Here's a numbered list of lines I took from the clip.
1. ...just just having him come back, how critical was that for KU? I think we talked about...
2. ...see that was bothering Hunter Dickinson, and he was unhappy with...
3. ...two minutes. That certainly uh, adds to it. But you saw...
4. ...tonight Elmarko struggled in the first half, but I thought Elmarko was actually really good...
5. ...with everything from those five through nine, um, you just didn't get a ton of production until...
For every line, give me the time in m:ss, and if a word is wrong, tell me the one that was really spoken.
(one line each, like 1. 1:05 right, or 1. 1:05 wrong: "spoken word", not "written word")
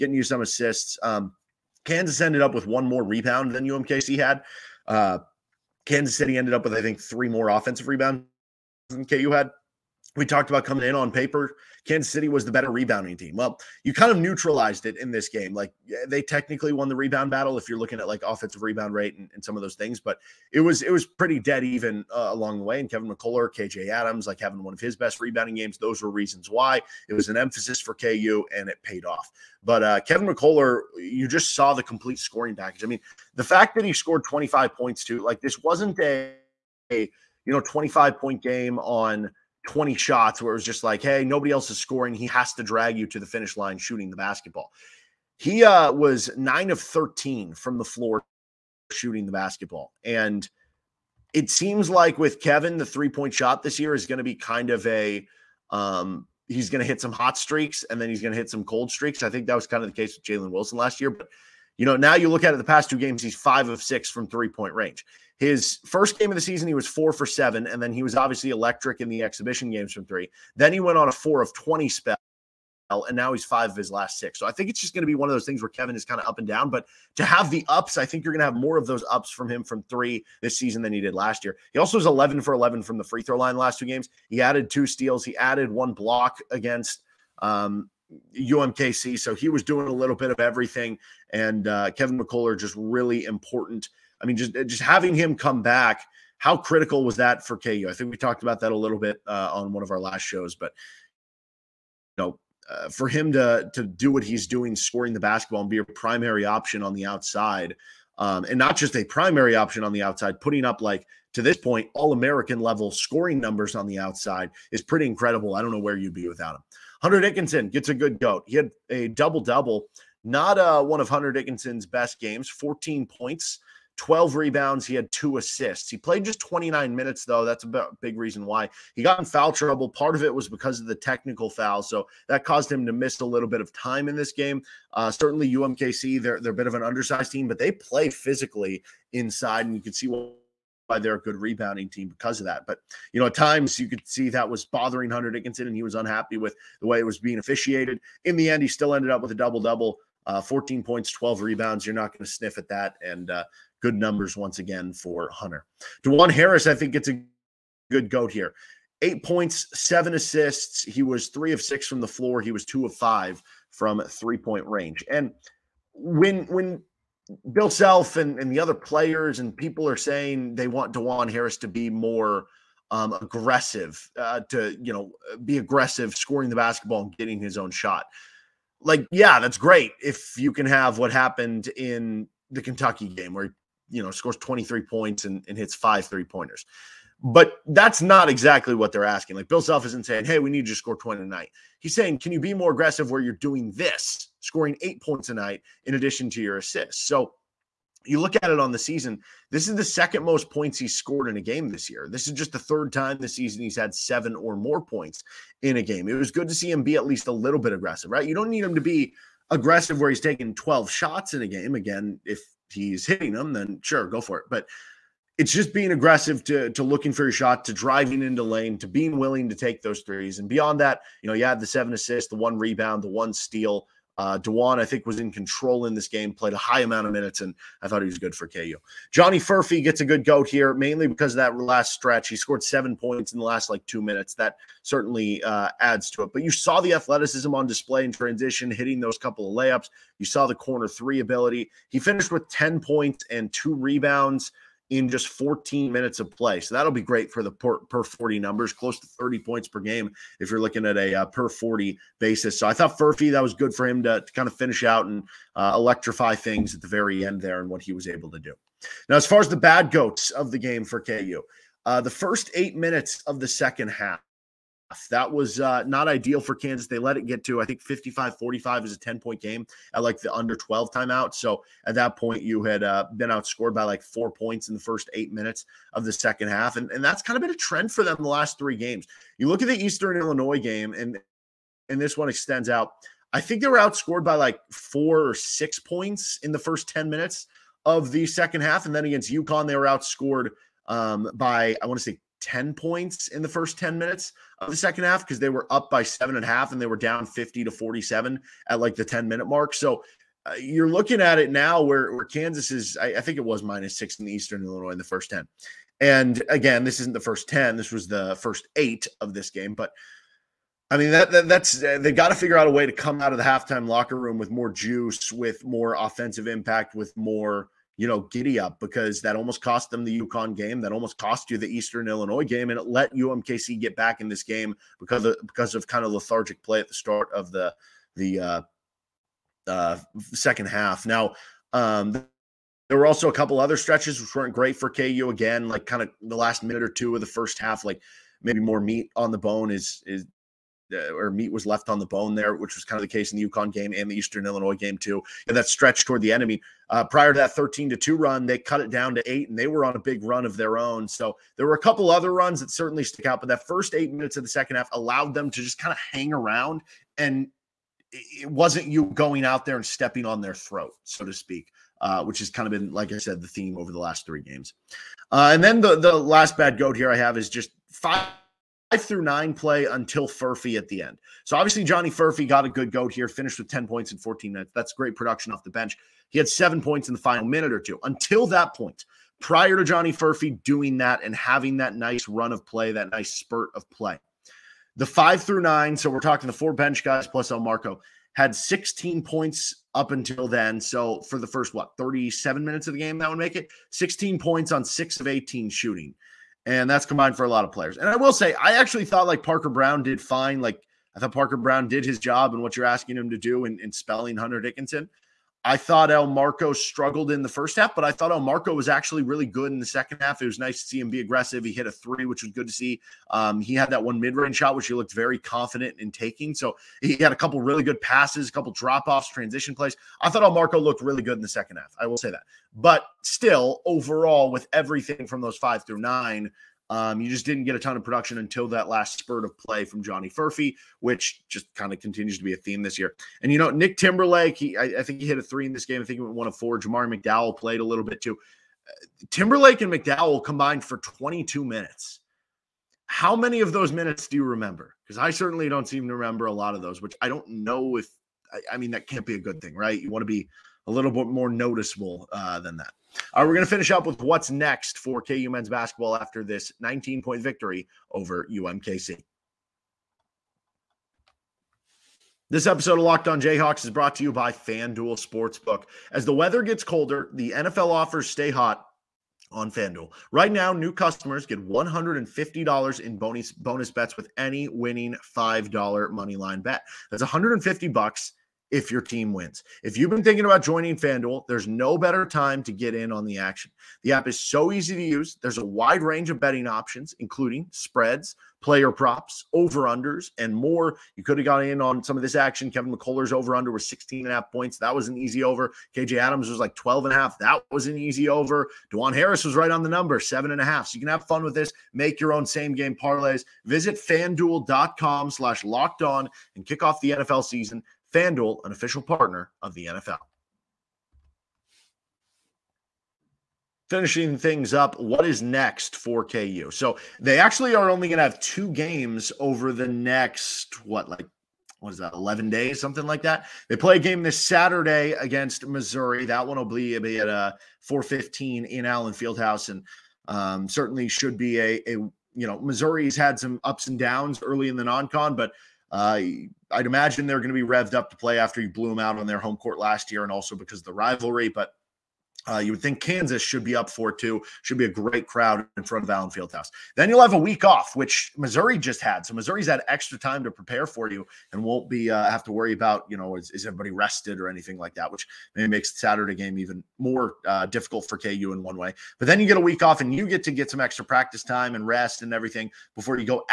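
1. 1:34 right
2. 2:24 right
3. 3:53 right
4. 6:45 wrong: "thought", not "tonight"
5. 7:04 right.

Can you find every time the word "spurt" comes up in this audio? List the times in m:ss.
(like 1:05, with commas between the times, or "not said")
6:23, 7:09.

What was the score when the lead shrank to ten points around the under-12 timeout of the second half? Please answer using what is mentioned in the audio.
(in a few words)
55-45.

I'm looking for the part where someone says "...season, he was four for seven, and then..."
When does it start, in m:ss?
1:06.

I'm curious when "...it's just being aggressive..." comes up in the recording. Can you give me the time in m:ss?
3:35.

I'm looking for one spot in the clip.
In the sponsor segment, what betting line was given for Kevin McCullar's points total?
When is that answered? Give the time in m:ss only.
8:13.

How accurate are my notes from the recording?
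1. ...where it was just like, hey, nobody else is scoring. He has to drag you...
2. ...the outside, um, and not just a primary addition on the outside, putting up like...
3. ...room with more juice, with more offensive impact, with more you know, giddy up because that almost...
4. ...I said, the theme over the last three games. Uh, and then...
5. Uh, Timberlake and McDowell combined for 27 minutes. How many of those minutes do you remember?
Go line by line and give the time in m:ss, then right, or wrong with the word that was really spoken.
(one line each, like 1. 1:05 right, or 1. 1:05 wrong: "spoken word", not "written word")
1. 0:40 right
2. 1:46 wrong: "option", not "addition"
3. 5:14 right
4. 6:03 right
5. 7:18 wrong: "22", not "27".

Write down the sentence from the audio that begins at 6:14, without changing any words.
That's great production off the bench.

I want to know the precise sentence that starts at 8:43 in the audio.
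They play a game this Saturday against Missouri.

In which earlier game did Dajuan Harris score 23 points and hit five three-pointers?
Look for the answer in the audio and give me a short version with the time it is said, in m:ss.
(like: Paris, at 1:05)
Kentucky, at 3:02.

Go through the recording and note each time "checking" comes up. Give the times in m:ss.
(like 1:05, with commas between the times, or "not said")
not said.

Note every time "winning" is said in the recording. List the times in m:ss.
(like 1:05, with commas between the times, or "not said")
7:54.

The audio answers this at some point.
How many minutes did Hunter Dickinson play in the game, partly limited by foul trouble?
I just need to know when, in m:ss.
2:06.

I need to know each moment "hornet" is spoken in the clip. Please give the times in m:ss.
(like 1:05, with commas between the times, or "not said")
not said.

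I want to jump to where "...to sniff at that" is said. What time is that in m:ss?
2:32.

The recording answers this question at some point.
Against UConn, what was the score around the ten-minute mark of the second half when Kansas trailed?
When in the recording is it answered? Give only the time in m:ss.
4:57.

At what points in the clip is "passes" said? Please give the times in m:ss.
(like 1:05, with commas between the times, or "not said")
6:57.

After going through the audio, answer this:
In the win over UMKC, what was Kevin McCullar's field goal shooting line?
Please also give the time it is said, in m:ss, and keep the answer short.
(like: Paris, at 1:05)
9 of 13, at 0:46.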